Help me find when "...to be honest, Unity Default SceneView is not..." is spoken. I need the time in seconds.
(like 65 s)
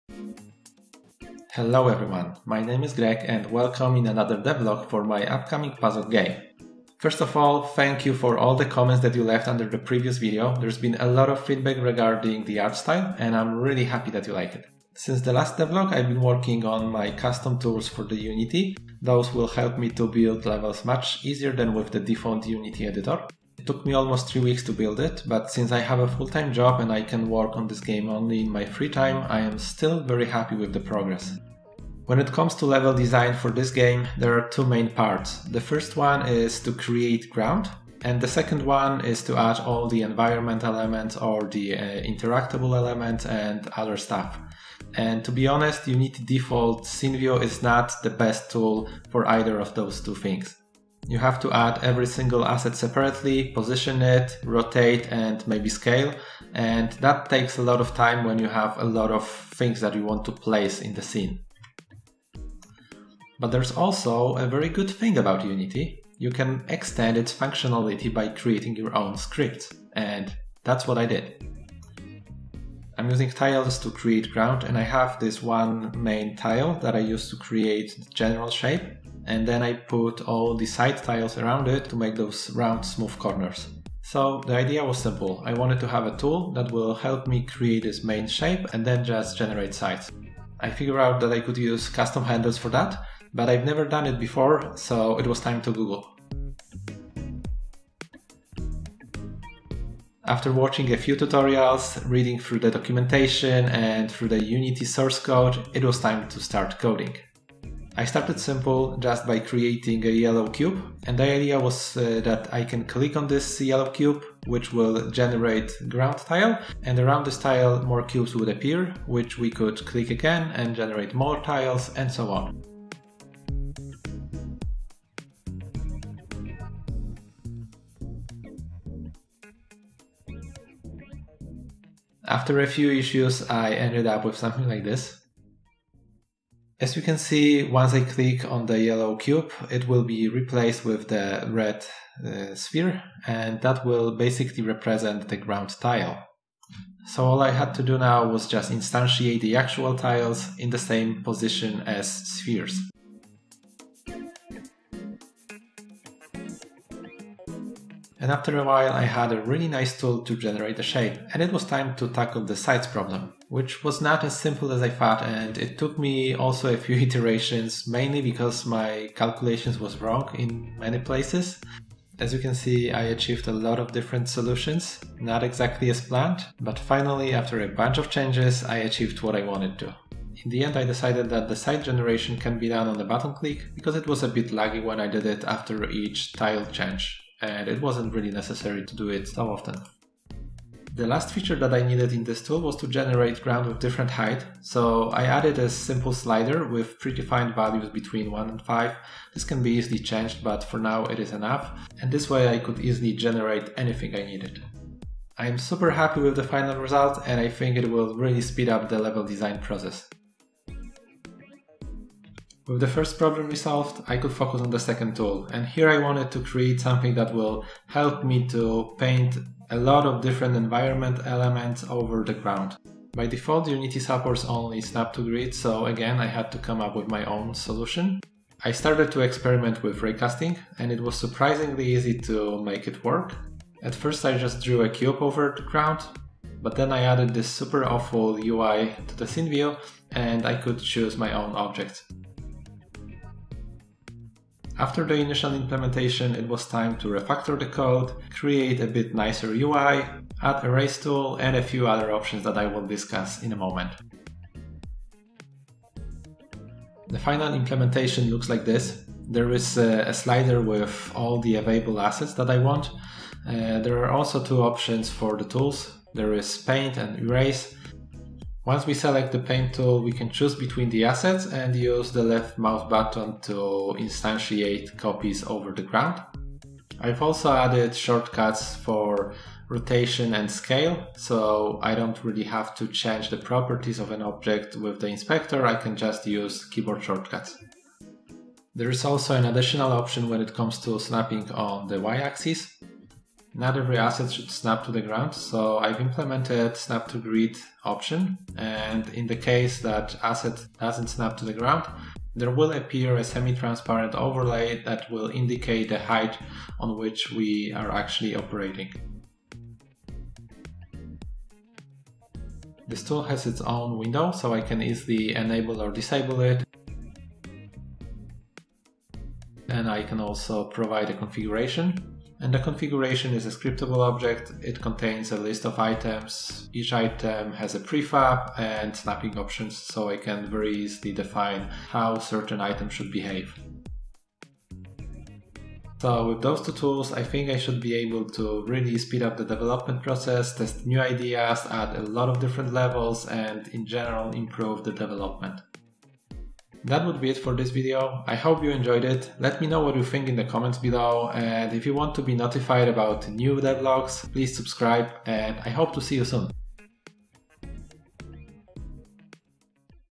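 45 s.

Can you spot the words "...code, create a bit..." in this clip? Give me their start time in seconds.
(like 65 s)
247 s.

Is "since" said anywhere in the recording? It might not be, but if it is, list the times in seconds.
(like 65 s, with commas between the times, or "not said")
14 s, 25 s.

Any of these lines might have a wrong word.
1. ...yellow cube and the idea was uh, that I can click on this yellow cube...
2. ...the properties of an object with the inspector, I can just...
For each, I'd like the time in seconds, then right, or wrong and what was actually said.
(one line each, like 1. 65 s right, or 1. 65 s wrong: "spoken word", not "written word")
1. 110 s right
2. 283 s right.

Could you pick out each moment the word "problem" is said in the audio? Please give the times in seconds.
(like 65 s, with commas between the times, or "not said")
162 s, 213 s.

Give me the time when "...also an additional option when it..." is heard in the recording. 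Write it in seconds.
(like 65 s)
289 s.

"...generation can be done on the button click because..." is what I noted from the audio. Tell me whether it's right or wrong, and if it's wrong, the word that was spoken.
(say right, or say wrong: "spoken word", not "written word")
right.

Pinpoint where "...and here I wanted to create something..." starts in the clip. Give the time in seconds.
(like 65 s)
215 s.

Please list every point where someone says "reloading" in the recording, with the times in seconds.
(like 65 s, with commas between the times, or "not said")
not said.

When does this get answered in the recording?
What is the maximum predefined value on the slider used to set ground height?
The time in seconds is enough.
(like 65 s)
198 s.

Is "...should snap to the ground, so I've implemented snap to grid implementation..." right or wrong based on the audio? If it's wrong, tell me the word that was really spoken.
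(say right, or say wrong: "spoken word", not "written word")
wrong: "option", not "implementation".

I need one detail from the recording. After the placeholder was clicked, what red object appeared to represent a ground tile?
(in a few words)
sphere.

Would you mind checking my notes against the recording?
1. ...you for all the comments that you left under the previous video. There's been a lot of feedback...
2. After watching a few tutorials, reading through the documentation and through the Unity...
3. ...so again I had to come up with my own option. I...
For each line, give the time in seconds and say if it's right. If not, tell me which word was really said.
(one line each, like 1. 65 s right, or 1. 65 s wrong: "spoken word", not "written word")
1. 8 s right
2. 100 s right
3. 225 s wrong: "solution", not "option".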